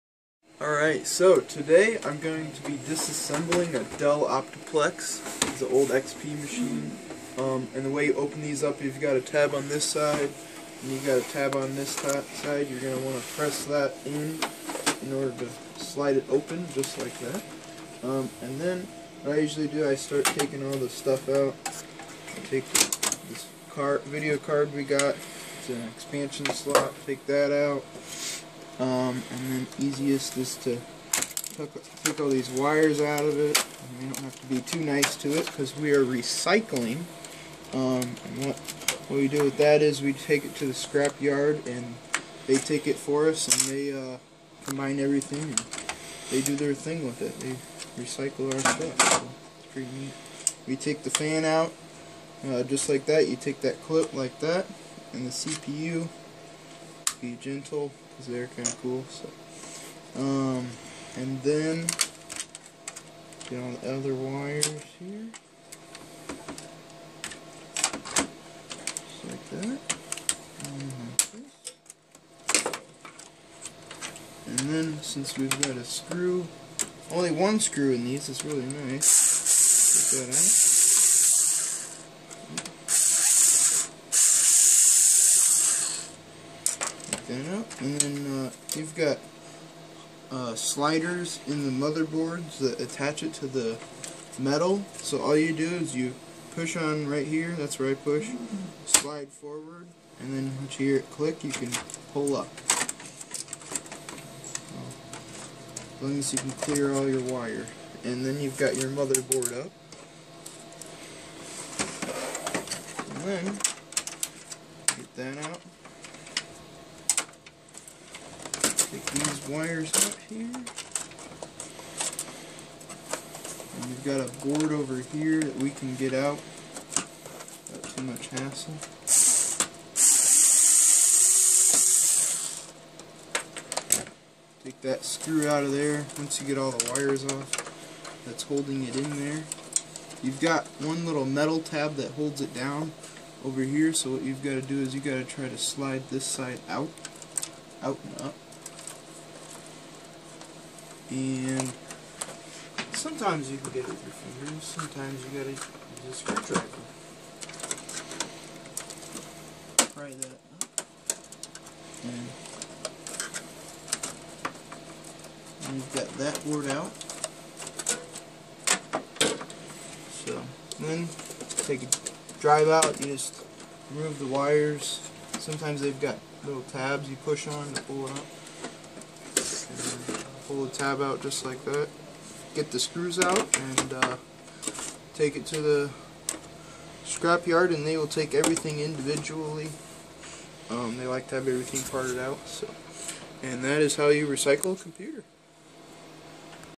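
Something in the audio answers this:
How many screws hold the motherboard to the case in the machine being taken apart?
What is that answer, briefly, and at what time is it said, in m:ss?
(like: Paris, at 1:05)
1, at 1:17.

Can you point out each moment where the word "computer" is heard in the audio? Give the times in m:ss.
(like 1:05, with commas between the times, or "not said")
3:14.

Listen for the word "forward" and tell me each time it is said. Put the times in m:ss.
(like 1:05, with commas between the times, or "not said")
1:39.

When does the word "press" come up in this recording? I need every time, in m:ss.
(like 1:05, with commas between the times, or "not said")
0:13.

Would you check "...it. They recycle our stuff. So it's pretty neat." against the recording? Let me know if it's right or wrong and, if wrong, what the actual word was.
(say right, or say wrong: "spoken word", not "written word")
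right.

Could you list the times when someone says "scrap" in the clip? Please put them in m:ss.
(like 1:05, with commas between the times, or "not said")
0:40, 3:07.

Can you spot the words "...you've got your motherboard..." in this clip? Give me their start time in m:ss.
1:48.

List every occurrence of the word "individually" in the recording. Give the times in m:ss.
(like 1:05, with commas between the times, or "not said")
3:08.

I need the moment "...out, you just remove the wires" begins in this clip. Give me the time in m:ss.
2:52.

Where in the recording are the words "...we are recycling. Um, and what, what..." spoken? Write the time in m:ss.
0:35.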